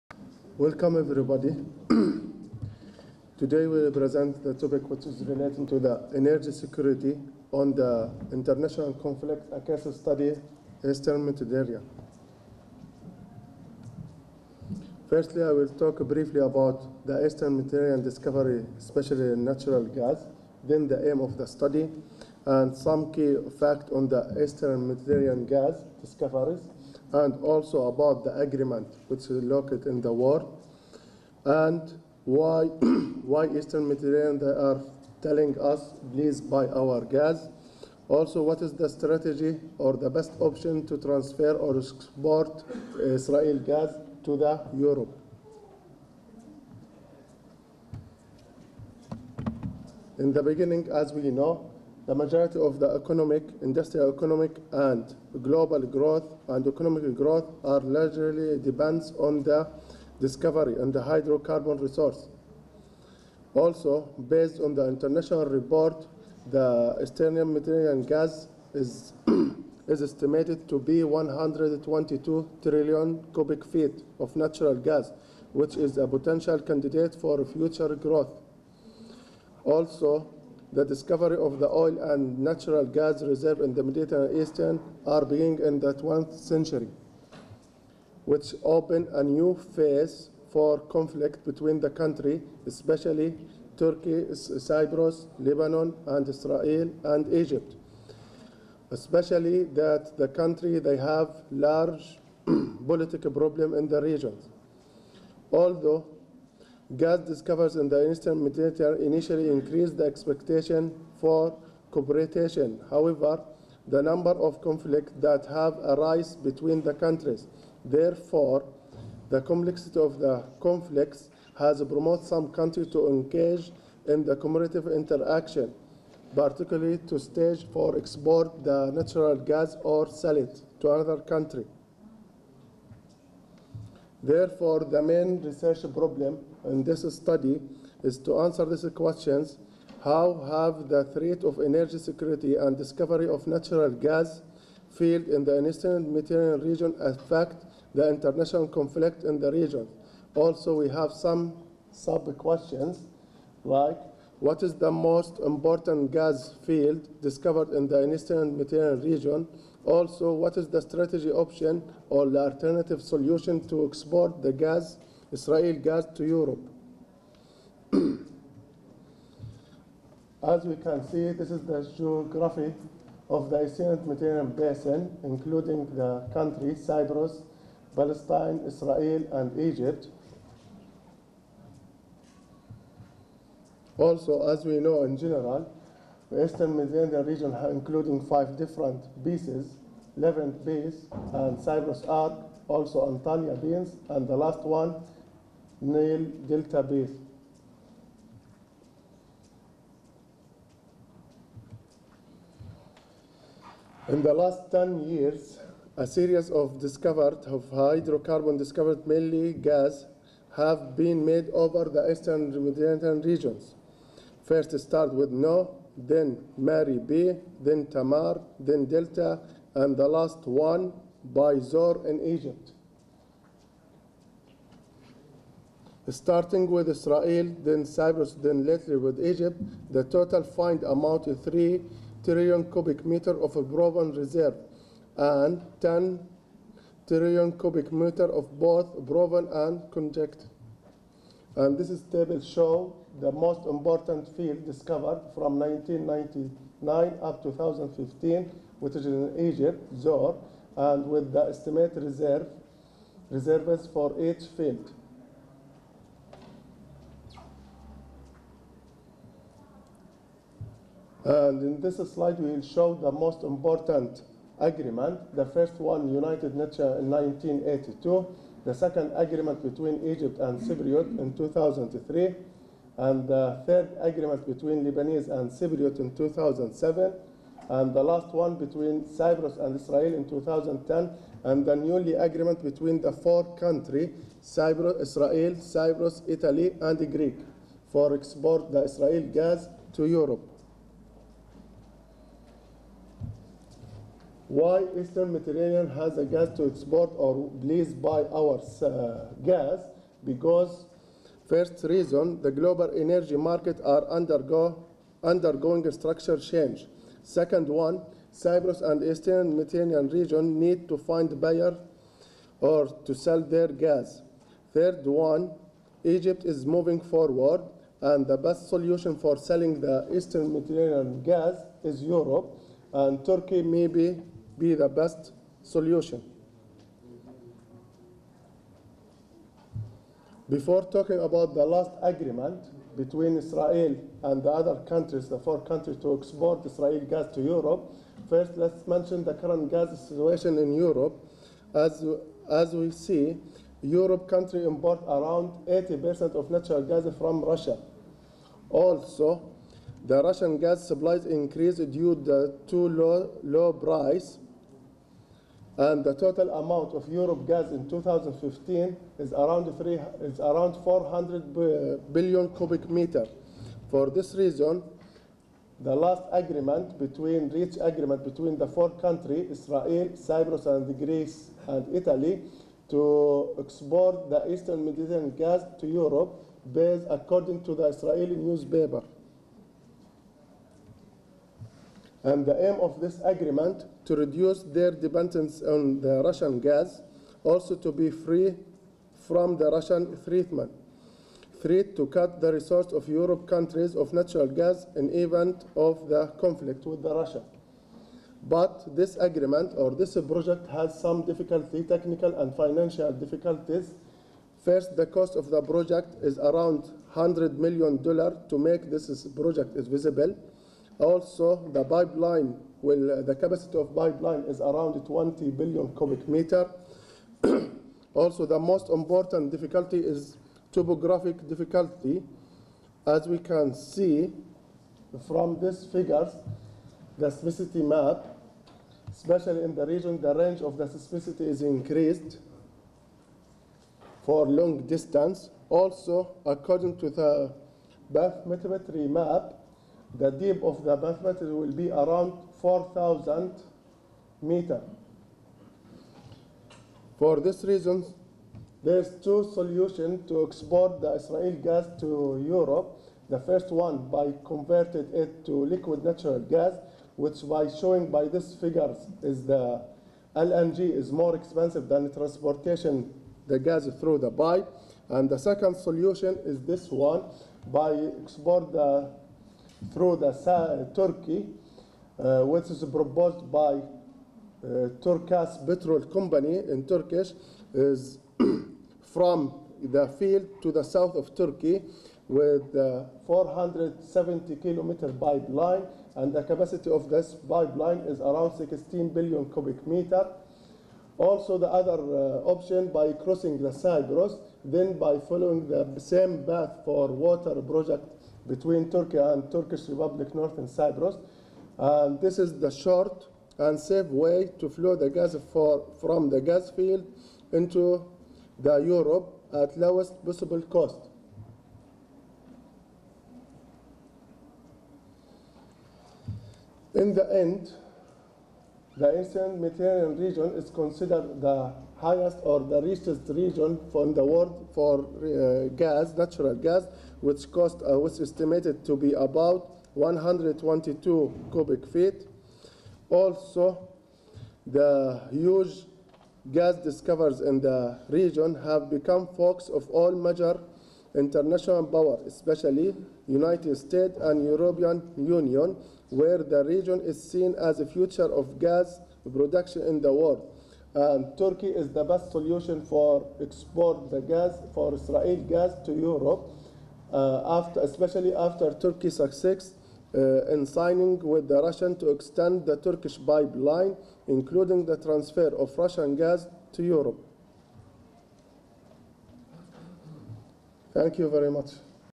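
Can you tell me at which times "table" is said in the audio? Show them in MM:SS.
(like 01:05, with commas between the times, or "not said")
04:02.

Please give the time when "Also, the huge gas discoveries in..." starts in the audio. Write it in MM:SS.
08:53.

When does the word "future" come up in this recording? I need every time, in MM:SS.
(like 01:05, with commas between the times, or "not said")
01:17, 09:07.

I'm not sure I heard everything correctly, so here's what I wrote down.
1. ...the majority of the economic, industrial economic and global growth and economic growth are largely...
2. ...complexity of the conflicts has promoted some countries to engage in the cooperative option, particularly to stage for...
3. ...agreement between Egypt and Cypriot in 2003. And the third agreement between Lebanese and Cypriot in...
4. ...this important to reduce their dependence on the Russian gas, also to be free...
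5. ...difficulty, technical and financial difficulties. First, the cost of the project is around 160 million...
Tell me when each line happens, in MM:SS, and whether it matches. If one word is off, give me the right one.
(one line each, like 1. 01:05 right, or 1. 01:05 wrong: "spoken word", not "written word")
1. 00:52 right
2. 01:59 wrong: "interaction", not "option"
3. 04:29 right
4. 06:23 wrong: "agreement", not "important"
5. 06:41 wrong: "100", not "160".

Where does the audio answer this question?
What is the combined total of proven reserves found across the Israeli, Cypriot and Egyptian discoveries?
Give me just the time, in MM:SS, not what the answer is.
03:51.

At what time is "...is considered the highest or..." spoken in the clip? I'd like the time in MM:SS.
08:40.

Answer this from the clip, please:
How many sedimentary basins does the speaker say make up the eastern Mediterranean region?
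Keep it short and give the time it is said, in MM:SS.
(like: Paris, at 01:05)
5, at 03:08.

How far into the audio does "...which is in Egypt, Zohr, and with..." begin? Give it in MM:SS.
04:08.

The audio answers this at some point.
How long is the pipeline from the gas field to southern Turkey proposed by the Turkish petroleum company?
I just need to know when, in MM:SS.
08:03.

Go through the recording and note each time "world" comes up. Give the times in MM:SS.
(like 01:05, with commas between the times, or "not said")
08:44, 09:10.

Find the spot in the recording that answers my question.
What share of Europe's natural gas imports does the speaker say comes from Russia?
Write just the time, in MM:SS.
05:45.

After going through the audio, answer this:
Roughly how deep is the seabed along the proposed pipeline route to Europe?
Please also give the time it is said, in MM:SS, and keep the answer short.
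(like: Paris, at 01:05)
4,000 meters, at 07:22.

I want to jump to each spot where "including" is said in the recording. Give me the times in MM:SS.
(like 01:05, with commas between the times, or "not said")
02:55, 03:07, 09:24.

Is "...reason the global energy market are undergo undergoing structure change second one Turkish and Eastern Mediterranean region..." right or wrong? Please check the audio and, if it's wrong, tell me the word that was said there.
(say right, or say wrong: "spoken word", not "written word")
wrong: "Cyprus", not "Turkish".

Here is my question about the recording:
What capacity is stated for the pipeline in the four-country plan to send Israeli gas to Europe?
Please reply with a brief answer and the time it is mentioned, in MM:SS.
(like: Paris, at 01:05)
20 billion cubic meters, at 06:55.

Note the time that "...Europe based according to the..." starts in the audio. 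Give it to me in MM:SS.
06:15.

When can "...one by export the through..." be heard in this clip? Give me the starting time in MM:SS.
07:46.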